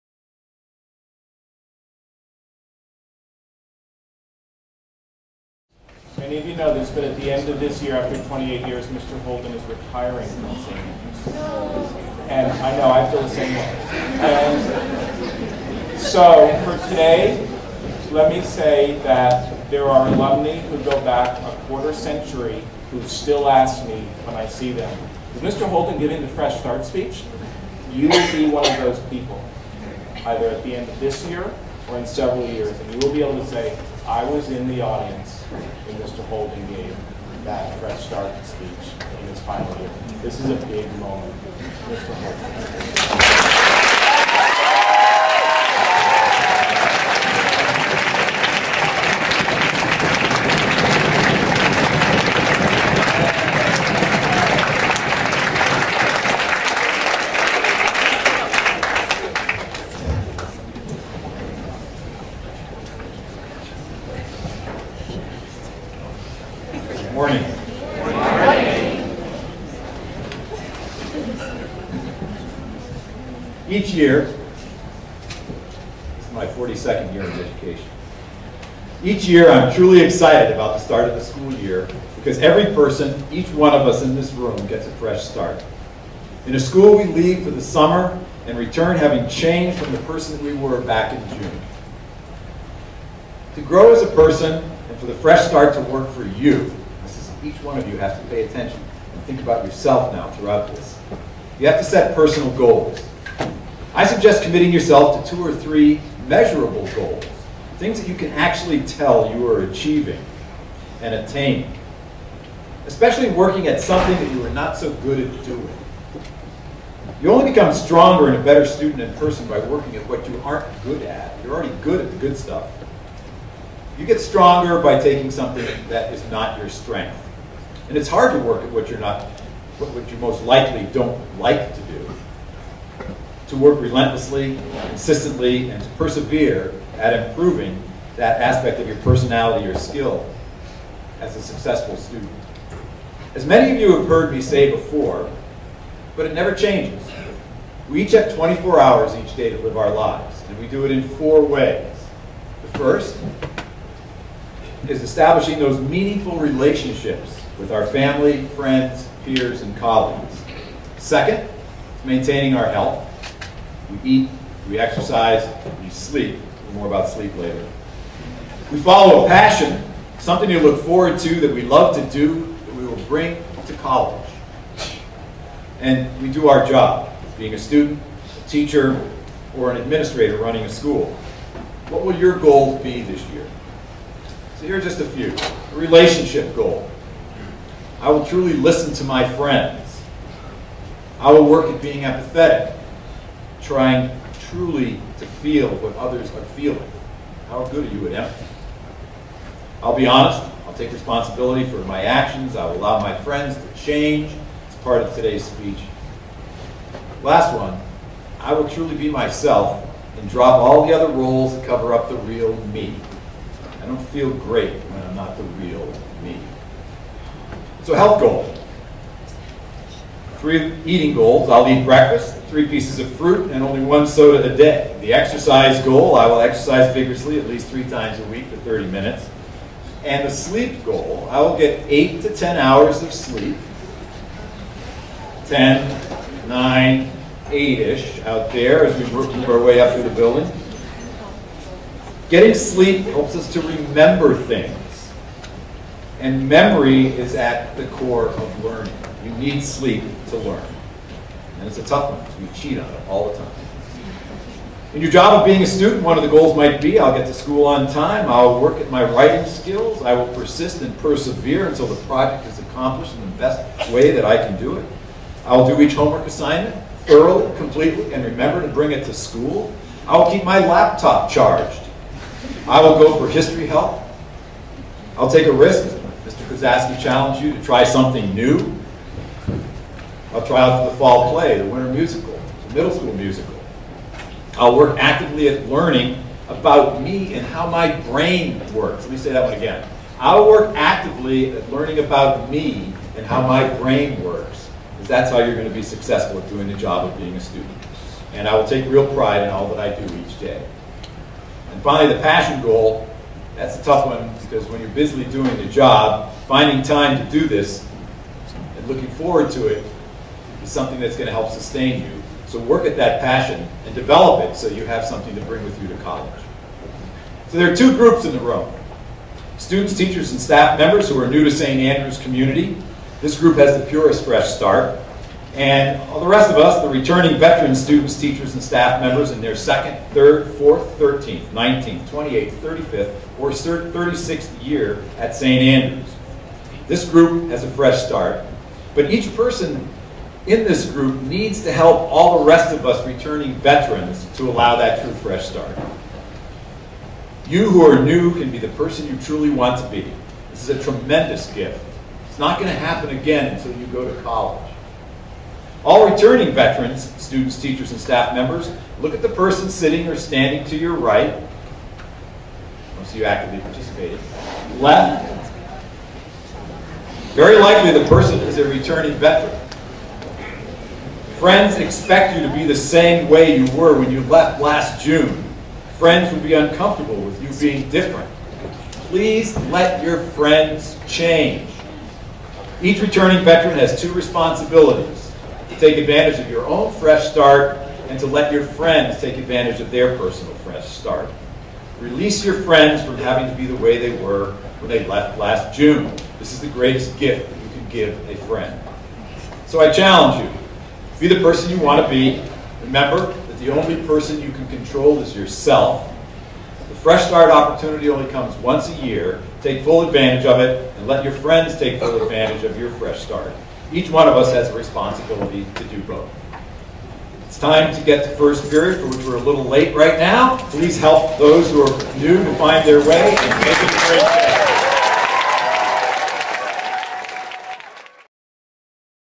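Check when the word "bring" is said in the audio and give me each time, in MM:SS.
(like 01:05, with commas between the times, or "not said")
02:53, 04:28, 05:15.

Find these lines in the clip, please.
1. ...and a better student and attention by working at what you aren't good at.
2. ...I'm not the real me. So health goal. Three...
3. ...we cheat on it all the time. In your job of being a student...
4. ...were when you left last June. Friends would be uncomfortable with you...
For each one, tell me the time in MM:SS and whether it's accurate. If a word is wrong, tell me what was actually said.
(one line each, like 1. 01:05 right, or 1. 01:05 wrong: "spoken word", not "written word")
1. 01:58 wrong: "person", not "attention"
2. 03:35 right
3. 04:12 right
4. 06:13 right.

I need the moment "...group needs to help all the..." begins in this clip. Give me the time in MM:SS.
05:40.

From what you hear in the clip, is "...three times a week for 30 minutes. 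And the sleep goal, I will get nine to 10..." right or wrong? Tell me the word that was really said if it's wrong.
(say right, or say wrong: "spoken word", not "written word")
wrong: "eight", not "nine".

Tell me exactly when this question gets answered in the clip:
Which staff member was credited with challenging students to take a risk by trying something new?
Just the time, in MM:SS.
04:36.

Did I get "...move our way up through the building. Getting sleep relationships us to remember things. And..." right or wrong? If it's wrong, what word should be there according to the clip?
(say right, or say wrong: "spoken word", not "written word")
wrong: "helps", not "relationships".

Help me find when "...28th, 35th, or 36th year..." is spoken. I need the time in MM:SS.
05:32.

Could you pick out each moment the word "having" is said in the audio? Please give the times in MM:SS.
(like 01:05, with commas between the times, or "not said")
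01:28, 06:33.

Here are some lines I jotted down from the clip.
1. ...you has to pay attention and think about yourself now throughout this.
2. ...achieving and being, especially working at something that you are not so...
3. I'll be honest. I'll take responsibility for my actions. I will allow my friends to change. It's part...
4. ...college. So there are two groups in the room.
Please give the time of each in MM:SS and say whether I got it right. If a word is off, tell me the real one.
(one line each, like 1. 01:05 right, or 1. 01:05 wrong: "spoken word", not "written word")
1. 01:37 right
2. 01:49 wrong: "attaining", not "being"
3. 03:19 right
4. 05:16 right.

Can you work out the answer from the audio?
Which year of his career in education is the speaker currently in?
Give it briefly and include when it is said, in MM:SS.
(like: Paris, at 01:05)
42nd, at 01:16.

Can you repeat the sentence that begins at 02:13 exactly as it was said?
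To work relentlessly, consistently, and to persevere at improving that aspect of your personality or skill as a successful student.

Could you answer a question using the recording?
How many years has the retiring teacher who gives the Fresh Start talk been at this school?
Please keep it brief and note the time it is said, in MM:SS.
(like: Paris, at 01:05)
28, at 00:08.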